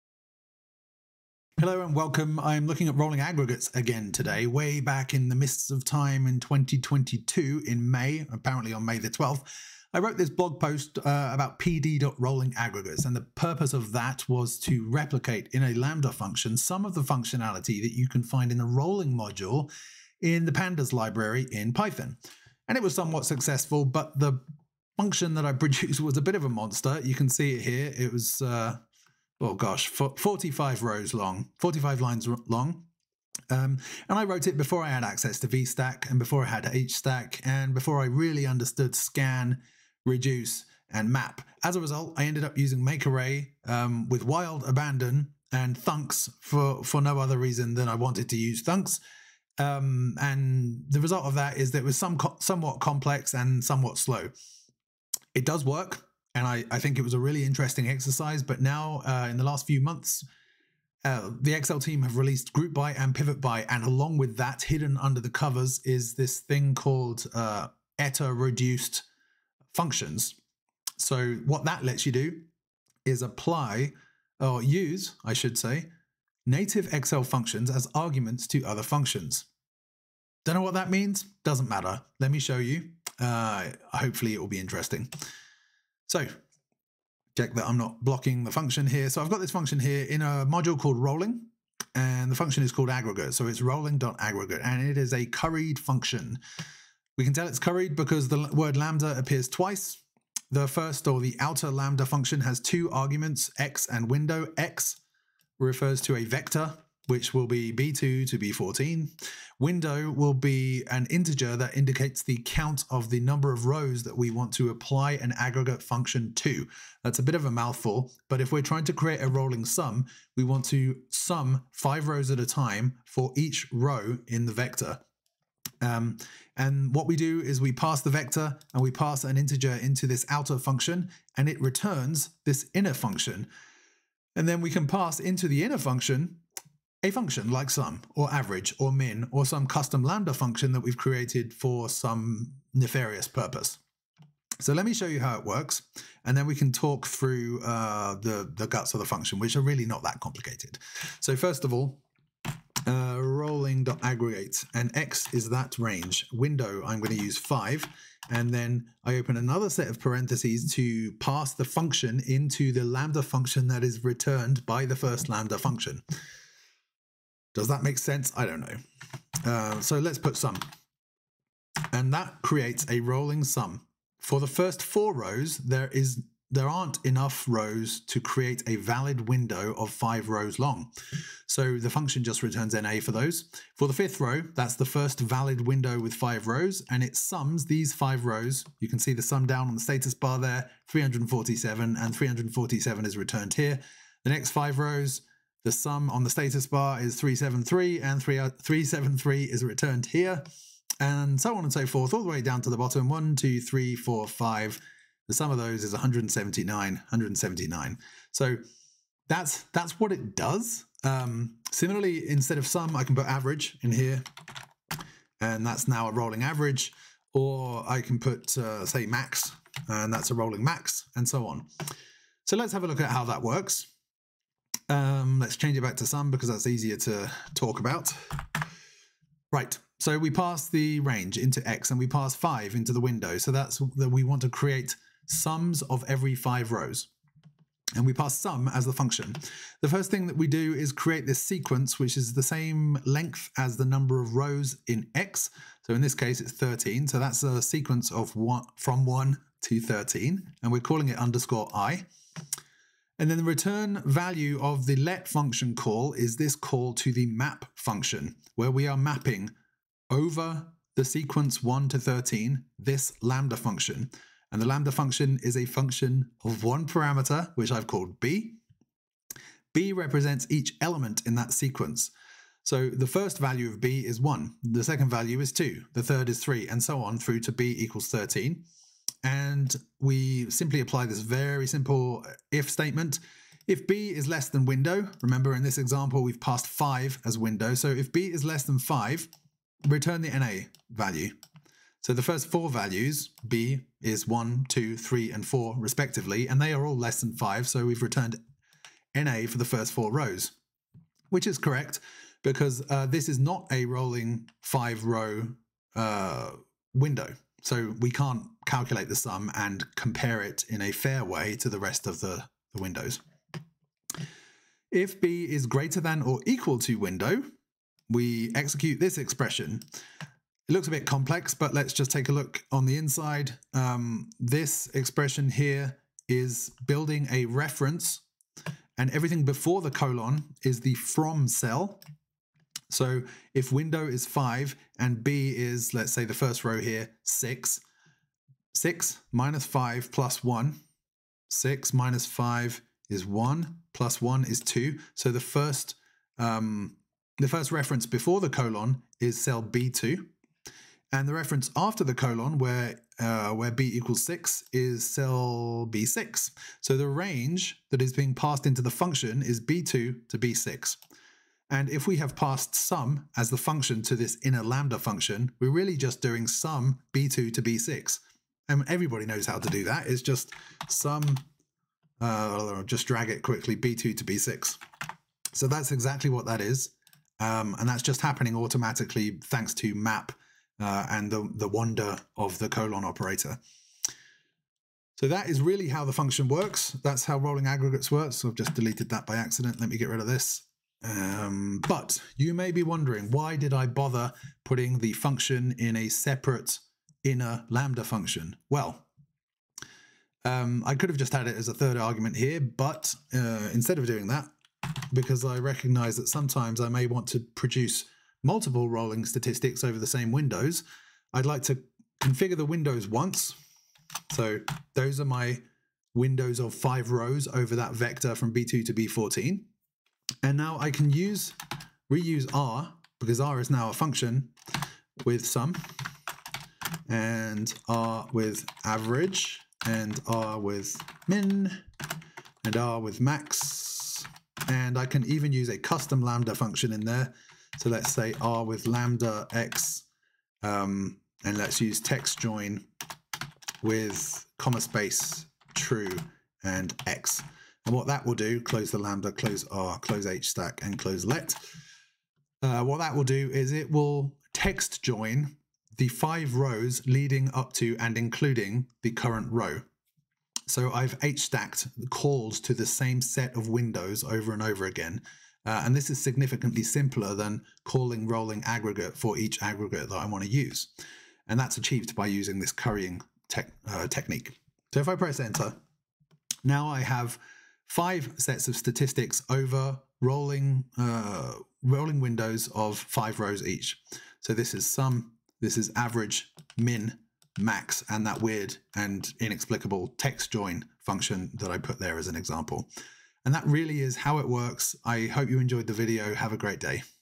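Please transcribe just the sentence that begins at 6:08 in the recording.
I mean, everybody knows how to do that.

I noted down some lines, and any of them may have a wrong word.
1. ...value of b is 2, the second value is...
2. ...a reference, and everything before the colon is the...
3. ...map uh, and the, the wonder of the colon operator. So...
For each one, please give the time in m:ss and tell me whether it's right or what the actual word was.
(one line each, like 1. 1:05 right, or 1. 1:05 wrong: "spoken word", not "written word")
1. 4:33 wrong: "1", not "2"
2. 5:27 right
3. 6:19 right.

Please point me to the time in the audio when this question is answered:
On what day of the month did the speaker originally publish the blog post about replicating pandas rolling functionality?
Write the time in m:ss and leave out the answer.
0:08.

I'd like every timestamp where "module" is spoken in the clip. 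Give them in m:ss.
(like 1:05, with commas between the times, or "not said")
0:19, 1:30.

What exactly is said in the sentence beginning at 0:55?
It does work and I, I think it was a really interesting exercise.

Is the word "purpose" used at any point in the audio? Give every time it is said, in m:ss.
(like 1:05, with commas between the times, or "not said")
0:13, 2:23.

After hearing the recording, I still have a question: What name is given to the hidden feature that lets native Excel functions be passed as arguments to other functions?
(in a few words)
ETA reduced functions.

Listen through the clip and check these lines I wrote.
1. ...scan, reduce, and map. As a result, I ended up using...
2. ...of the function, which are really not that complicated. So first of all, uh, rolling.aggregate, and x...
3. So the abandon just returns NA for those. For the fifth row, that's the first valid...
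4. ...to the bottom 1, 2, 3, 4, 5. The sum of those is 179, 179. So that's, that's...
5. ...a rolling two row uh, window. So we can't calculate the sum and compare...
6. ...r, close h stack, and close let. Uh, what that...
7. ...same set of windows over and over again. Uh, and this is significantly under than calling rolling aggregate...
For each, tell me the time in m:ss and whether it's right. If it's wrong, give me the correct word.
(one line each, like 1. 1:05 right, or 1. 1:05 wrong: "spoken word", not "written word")
1. 0:38 right
2. 2:28 right
3. 3:01 wrong: "function", not "abandon"
4. 3:22 right
5. 5:03 wrong: "five", not "two"
6. 7:29 right
7. 7:42 wrong: "simpler", not "under".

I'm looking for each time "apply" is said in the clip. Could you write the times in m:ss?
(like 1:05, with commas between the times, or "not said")
1:13, 1:54, 4:40.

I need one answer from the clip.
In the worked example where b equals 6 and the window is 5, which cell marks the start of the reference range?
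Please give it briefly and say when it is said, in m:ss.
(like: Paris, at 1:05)
B2, at 5:49.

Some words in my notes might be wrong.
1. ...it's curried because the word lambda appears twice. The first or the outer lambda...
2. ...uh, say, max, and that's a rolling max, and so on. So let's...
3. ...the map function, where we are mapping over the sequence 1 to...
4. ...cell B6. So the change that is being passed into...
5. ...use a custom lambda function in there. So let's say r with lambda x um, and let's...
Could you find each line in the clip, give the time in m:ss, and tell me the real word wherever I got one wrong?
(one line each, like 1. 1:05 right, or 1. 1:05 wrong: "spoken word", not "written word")
1. 1:37 right
2. 3:38 right
3. 4:17 right
4. 5:55 wrong: "range", not "change"
5. 7:15 right.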